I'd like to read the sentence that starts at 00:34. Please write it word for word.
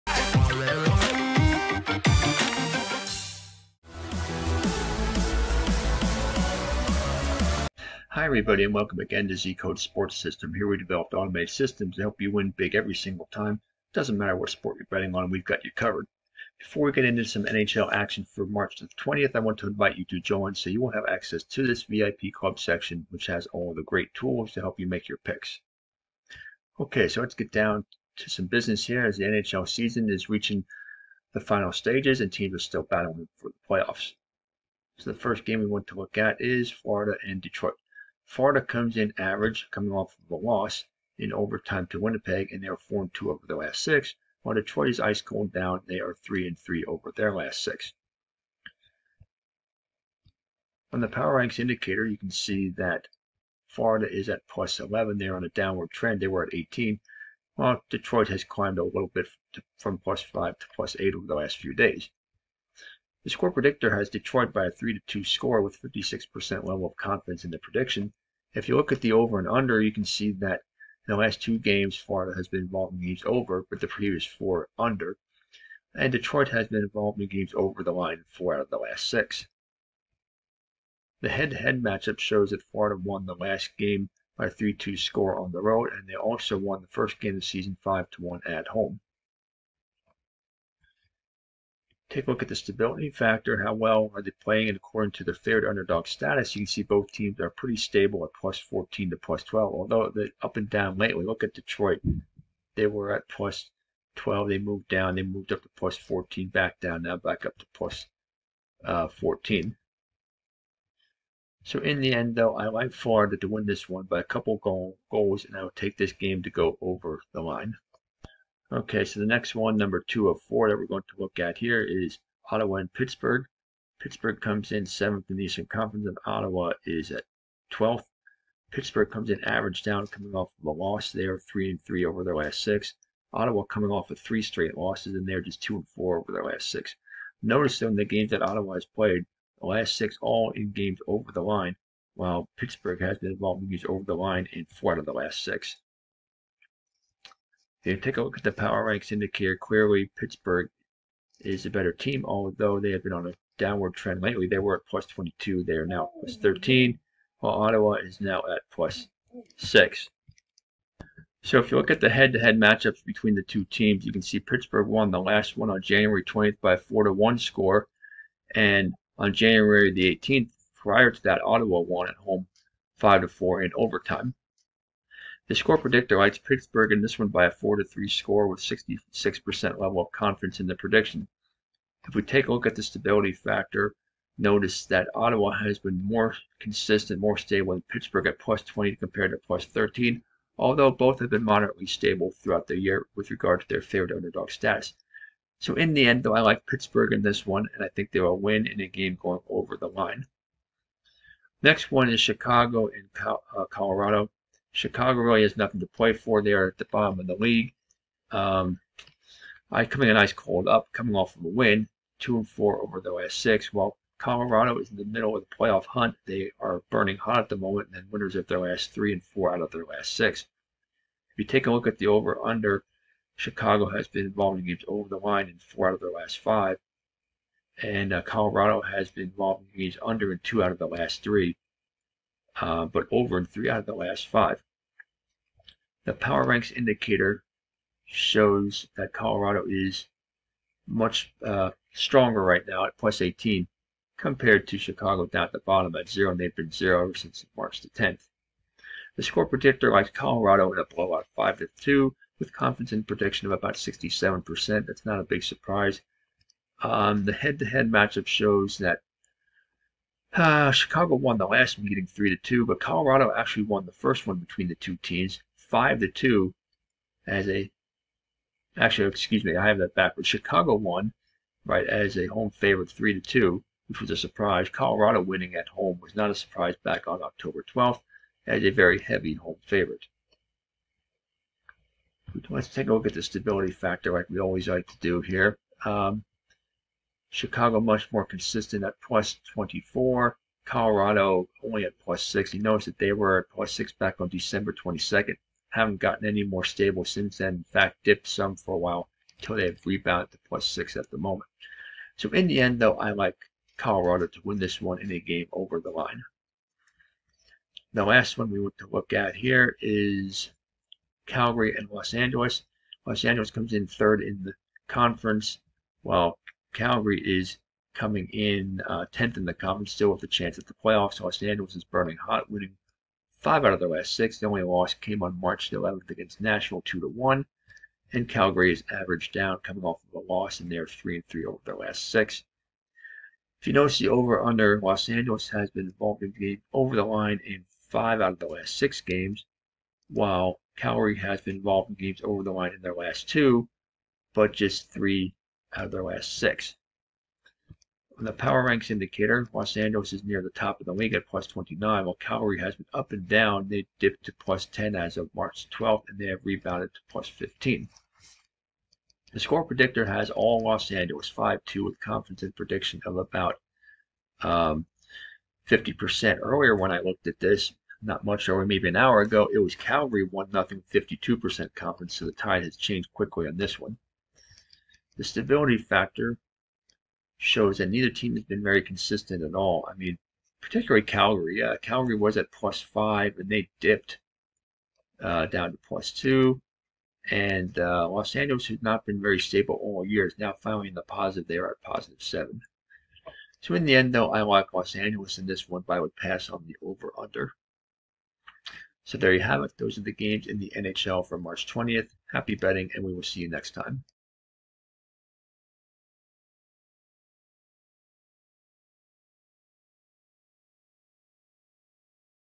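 So the first game we want to look at is Florida and Detroit.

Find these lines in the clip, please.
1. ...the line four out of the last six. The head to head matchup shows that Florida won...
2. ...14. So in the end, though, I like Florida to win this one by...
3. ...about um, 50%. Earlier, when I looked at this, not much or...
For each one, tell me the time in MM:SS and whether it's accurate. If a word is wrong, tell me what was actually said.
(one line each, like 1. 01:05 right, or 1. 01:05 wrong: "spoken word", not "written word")
1. 01:17 right
2. 01:49 right
3. 06:03 right.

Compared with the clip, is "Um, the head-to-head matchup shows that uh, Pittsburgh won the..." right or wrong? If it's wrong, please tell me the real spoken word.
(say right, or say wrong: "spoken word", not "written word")
wrong: "Chicago", not "Pittsburgh".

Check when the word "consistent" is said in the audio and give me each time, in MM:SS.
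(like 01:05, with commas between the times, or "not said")
03:06, 04:48, 06:18.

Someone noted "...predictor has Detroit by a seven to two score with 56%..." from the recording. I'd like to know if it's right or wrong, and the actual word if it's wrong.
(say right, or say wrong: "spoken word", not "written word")
wrong: "three", not "seven".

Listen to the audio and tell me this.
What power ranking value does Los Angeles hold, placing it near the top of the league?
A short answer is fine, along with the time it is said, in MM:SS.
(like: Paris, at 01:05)
plus 29, at 05:51.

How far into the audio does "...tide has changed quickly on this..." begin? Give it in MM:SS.
06:12.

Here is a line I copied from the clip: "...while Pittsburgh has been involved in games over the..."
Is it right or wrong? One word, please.
right.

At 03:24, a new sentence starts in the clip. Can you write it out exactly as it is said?
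Chicago really has nothing to play for.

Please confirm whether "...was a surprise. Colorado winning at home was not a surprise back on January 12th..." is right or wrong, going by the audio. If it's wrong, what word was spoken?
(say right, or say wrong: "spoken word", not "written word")
wrong: "October", not "January".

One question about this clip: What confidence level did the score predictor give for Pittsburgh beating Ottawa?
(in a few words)
66%.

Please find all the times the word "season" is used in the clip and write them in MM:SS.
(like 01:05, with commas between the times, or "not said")
00:29, 01:27.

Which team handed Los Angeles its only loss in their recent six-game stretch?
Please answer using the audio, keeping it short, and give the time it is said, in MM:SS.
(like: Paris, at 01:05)
Nashville, at 05:26.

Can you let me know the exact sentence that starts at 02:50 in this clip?
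Prior to that, Ottawa won at home 5 to 4 in overtime.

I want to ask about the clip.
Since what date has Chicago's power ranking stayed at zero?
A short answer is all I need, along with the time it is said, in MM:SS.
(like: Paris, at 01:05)
March 10th, at 04:07.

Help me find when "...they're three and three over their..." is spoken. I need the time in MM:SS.
05:30.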